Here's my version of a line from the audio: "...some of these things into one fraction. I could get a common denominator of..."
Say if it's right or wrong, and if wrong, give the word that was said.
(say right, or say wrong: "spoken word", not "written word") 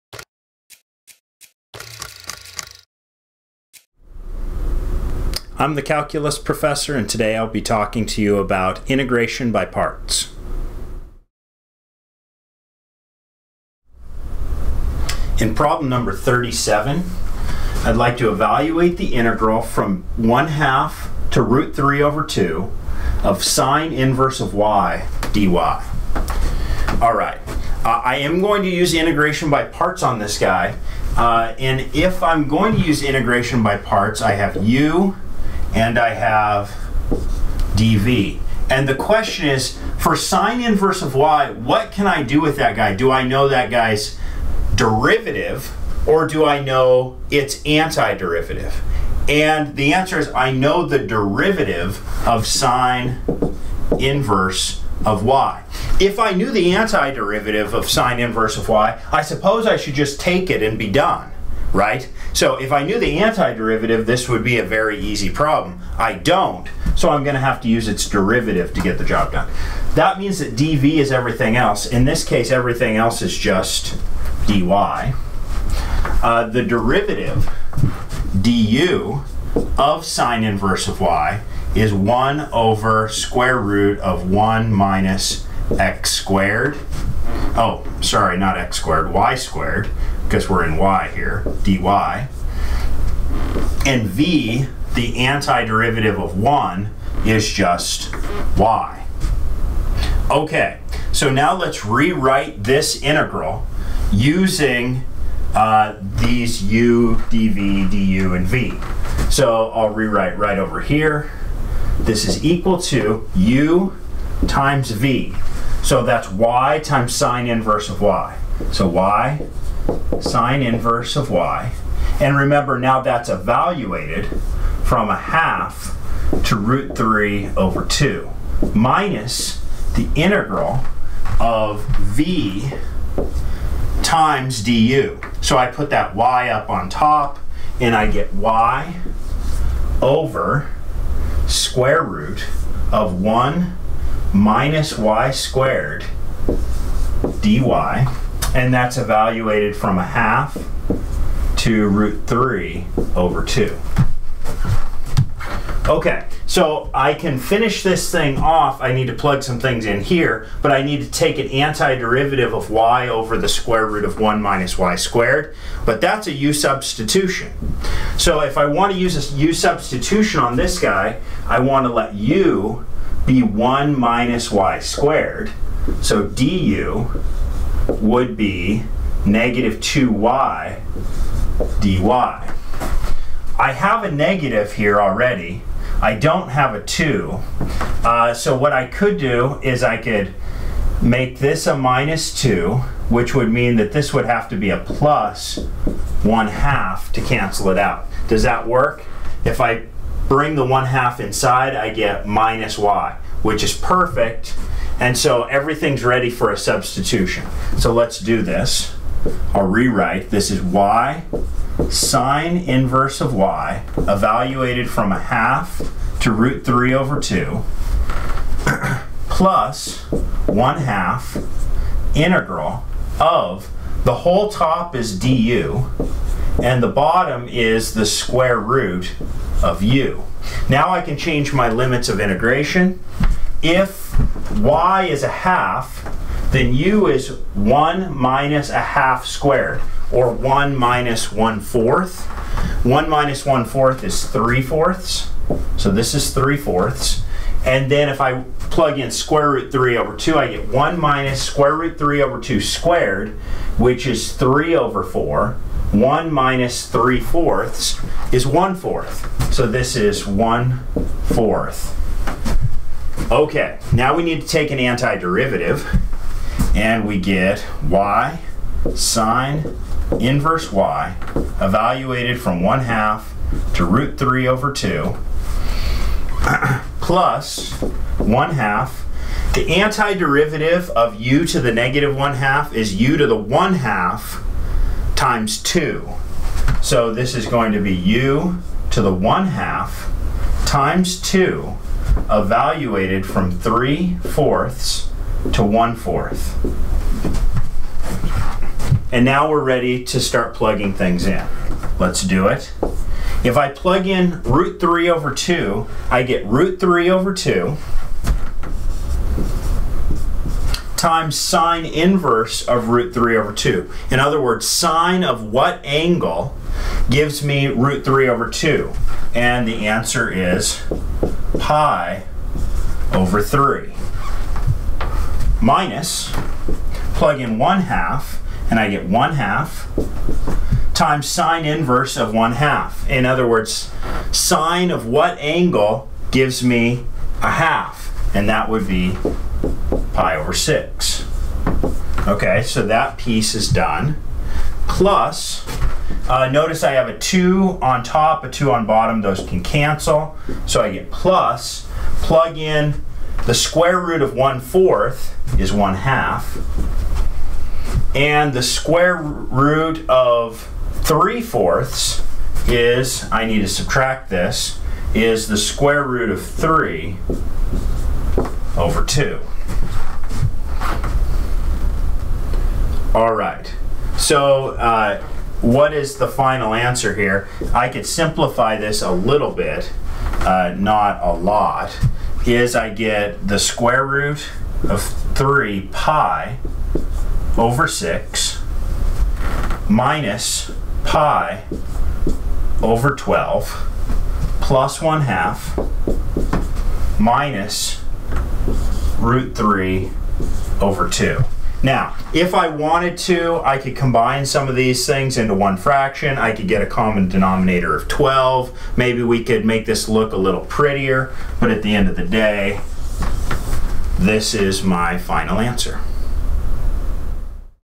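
right.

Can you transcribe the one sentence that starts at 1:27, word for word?
Oh, sorry, not x squared, y squared because we're in y here, dy.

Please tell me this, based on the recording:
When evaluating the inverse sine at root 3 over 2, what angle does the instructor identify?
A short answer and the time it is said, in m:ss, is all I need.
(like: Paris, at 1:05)
pi/3, at 5:21.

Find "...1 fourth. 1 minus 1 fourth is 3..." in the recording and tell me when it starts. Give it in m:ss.
4:01.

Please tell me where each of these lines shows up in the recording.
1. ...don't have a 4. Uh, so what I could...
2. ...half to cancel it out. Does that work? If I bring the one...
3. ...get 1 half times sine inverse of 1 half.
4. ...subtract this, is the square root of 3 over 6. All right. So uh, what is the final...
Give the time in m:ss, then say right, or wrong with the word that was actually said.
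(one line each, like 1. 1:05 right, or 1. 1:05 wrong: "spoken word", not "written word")
1. 3:06 wrong: "2", not "4"
2. 3:16 right
3. 5:28 right
4. 6:03 wrong: "2", not "6".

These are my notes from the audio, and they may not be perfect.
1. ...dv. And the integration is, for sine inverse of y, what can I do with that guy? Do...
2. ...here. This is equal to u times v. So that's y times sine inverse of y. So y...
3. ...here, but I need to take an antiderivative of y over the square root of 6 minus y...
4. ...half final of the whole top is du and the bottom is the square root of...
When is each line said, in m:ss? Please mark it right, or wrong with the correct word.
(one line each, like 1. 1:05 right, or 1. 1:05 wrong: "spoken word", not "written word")
1. 0:37 wrong: "question", not "integration"
2. 1:50 right
3. 2:40 wrong: "1", not "6"
4. 3:40 wrong: "integral", not "final".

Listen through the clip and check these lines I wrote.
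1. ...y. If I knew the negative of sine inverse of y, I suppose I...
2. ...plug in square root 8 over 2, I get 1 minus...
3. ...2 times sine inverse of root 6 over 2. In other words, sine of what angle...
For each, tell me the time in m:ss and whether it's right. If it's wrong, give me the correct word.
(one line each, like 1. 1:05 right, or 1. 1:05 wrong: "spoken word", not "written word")
1. 0:55 wrong: "antiderivative", not "negative"
2. 4:08 wrong: "3", not "8"
3. 5:07 wrong: "3", not "6".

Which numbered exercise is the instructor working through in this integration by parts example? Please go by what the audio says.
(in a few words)
37.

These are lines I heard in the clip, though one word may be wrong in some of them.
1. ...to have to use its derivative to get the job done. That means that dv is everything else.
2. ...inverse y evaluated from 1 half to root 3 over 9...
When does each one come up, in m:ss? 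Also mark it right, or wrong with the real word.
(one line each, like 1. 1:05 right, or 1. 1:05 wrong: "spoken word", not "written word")
1. 1:07 right
2. 4:30 wrong: "2", not "9".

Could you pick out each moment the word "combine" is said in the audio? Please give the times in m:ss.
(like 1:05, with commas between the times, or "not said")
6:43.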